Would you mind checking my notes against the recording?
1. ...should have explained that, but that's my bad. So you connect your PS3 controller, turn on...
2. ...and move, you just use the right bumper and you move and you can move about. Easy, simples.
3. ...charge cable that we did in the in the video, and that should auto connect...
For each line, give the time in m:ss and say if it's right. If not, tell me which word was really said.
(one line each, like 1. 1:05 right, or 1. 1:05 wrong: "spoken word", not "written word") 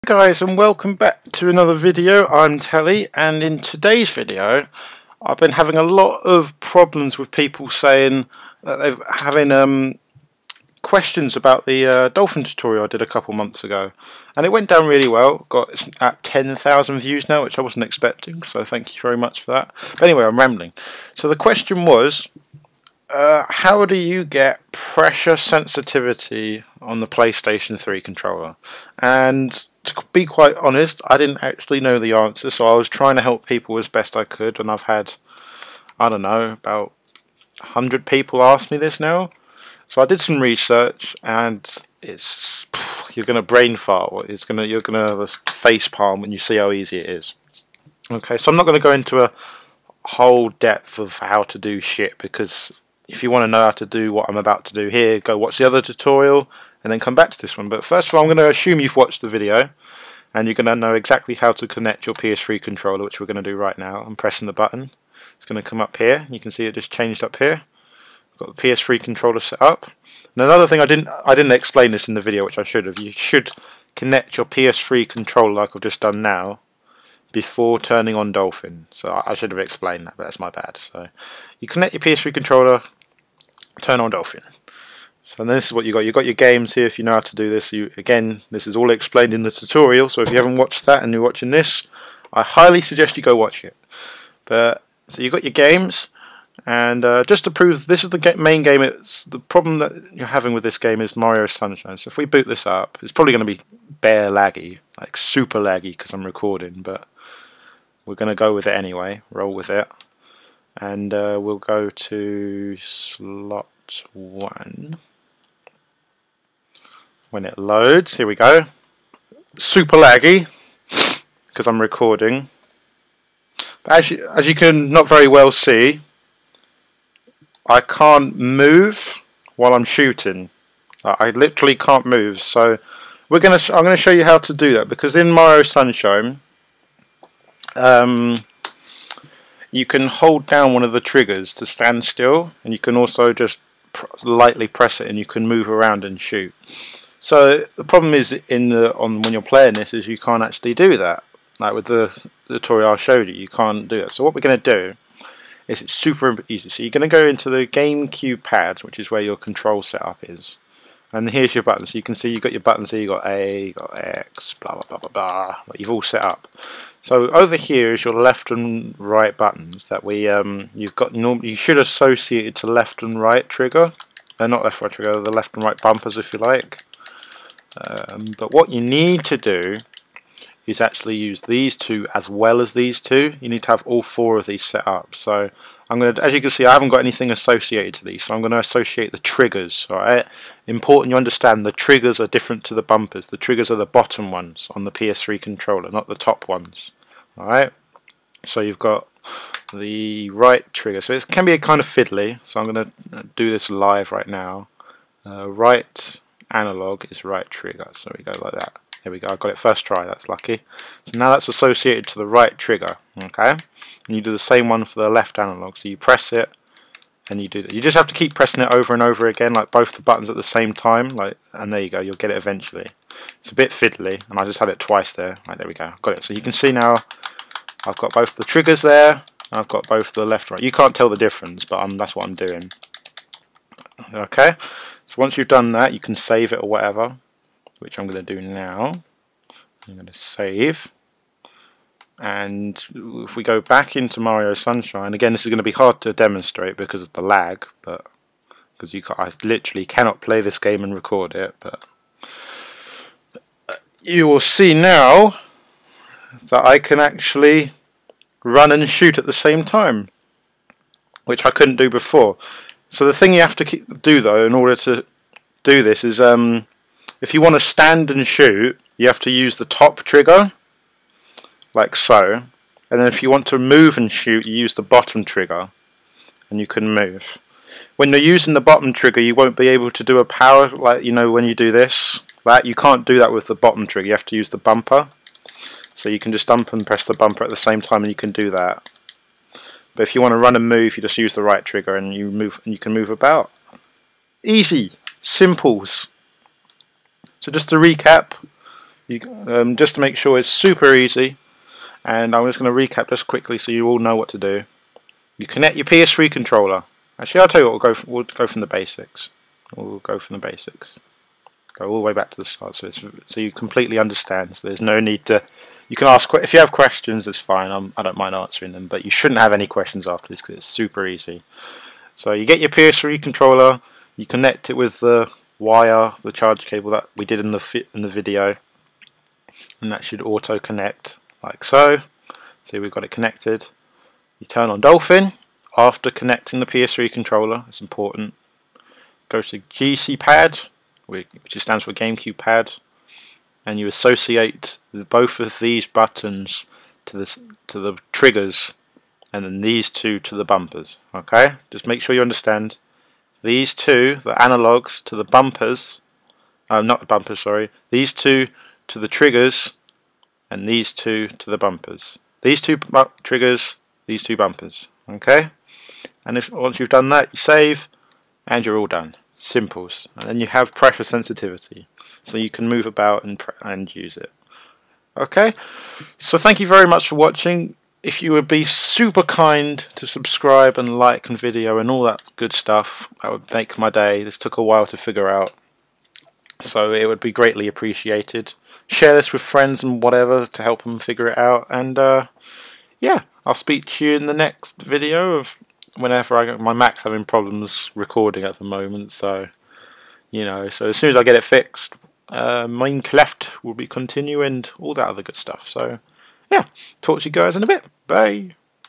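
1. 1:19 right
2. 4:50 wrong: "trigger", not "bumper"
3. 5:26 right.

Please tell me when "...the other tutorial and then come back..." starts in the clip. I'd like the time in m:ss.
0:55.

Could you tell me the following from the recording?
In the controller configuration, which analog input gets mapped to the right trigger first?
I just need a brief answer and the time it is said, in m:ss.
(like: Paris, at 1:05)
Right analog, at 3:25.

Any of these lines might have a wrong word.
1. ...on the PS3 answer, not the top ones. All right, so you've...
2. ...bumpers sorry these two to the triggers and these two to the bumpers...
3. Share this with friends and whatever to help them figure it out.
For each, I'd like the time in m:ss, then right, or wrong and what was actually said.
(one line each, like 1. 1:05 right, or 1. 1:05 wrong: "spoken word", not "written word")
1. 3:14 wrong: "controller", not "answer"
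2. 5:57 right
3. 6:28 right.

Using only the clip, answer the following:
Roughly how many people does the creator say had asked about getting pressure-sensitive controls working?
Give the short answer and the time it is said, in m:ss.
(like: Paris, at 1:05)
About 100, at 0:36.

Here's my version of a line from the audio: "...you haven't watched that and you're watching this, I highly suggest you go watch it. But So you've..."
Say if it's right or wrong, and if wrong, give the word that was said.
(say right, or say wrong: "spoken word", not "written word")
right.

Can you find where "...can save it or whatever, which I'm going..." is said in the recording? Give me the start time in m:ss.
3:55.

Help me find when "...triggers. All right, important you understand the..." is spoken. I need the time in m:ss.
3:09.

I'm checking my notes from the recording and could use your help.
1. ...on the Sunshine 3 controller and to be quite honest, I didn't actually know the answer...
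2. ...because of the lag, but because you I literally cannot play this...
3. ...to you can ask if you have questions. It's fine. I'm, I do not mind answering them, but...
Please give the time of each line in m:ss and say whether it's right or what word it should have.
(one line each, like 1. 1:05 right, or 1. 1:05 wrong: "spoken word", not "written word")
1. 0:26 wrong: "PlayStation", not "Sunshine"
2. 4:06 right
3. 5:15 right.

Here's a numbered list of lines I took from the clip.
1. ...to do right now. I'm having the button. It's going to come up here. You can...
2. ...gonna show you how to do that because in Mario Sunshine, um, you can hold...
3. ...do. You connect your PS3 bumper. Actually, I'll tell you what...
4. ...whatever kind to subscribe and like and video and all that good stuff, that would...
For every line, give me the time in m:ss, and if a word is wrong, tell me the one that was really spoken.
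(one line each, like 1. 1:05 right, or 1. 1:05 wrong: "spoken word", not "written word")
1. 1:03 wrong: "pressing", not "having"
2. 2:13 right
3. 5:04 wrong: "controller", not "bumper"
4. 6:18 wrong: "super", not "whatever".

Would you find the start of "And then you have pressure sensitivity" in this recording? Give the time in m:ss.
6:10.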